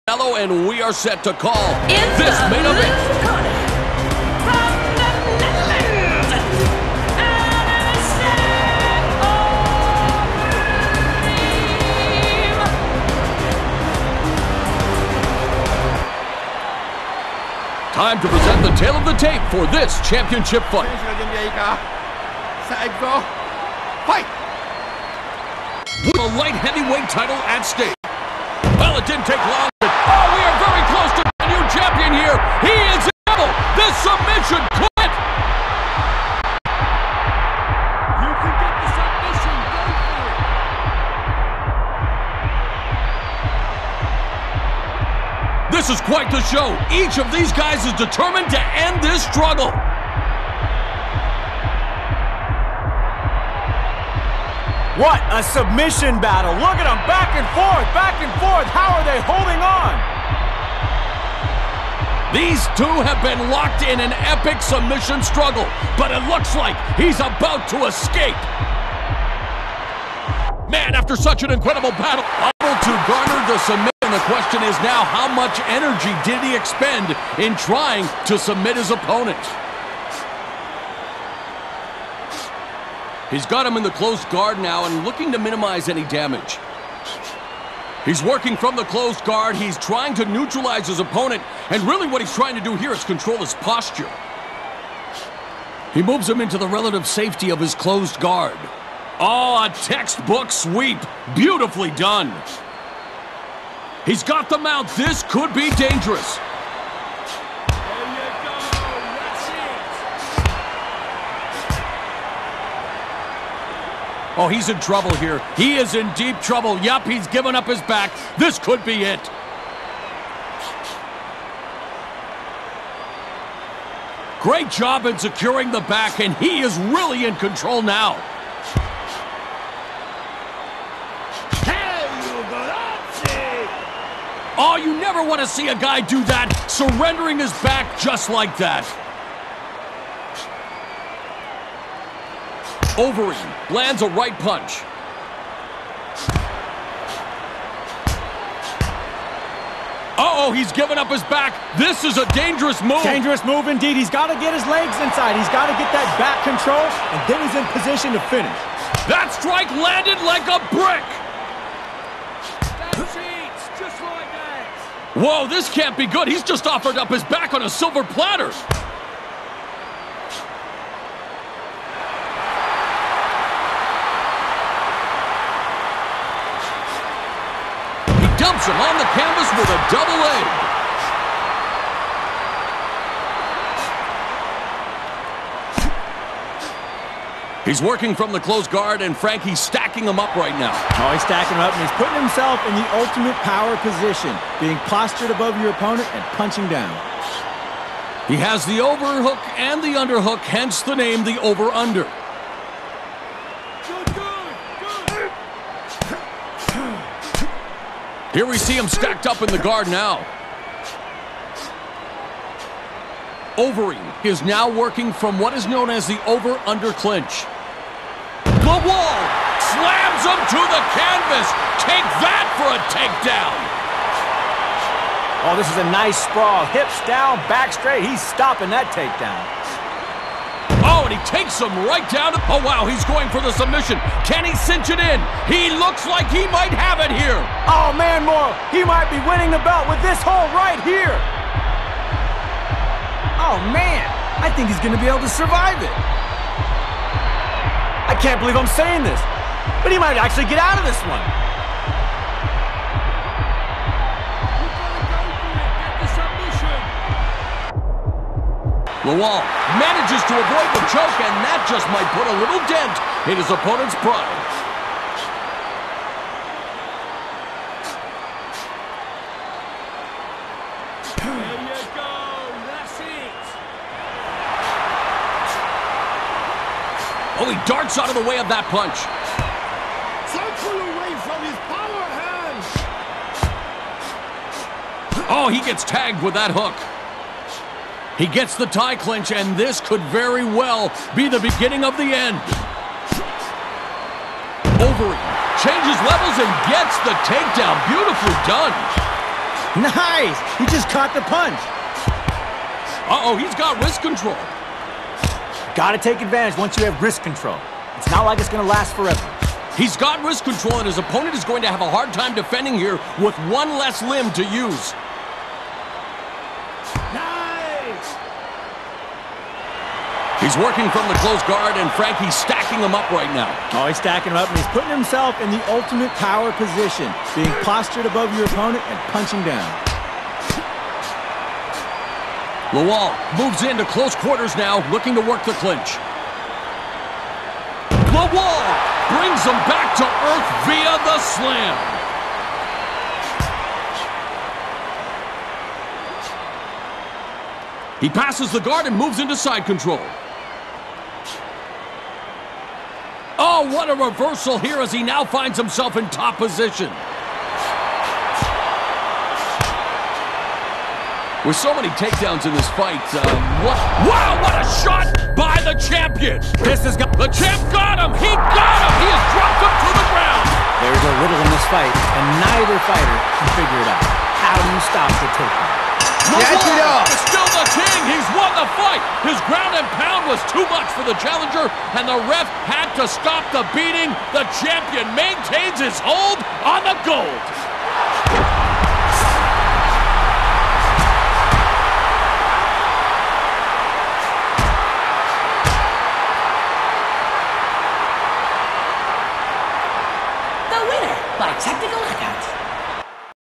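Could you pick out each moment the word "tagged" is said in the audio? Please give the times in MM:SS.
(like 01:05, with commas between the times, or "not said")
04:45.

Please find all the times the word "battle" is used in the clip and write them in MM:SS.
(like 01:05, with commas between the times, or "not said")
00:56, 01:11.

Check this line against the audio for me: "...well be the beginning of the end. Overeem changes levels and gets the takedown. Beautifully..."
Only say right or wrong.
right.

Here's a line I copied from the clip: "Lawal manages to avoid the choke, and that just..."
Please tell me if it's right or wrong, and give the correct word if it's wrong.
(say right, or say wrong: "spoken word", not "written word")
right.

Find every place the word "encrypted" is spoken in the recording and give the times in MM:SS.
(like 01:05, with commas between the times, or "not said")
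not said.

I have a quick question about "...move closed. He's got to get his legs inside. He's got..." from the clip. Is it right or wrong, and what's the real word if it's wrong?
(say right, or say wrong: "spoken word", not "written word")
wrong: "indeed", not "closed".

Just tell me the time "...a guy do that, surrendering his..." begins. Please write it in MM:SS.
02:15.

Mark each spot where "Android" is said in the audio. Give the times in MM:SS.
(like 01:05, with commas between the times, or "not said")
not said.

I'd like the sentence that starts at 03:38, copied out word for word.
The wall slams him to the canvas.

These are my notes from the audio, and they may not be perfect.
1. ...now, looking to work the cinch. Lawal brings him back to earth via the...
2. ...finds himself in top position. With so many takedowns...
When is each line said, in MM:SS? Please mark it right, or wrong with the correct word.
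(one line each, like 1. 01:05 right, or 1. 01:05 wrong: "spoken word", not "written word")
1. 05:34 wrong: "clinch", not "cinch"
2. 05:55 right.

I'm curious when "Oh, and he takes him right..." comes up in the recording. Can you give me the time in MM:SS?
03:50.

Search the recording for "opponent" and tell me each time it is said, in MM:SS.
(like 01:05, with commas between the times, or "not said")
01:18, 01:30, 03:15, 04:23, 05:10, 05:28.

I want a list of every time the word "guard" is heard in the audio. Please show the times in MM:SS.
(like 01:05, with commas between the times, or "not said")
01:24, 01:29, 01:38, 03:08, 03:29, 05:21, 05:48.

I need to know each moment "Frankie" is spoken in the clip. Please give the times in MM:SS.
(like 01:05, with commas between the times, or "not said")
03:09, 05:21.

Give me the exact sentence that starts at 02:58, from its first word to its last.
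dumps him on the canvas with a double A.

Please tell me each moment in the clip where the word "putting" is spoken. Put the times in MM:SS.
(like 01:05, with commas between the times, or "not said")
03:11, 05:24.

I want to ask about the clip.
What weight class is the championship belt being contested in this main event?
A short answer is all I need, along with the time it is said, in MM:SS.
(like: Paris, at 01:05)
Light heavyweight, at 00:26.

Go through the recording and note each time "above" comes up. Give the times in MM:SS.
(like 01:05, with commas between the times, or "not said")
03:15, 05:28.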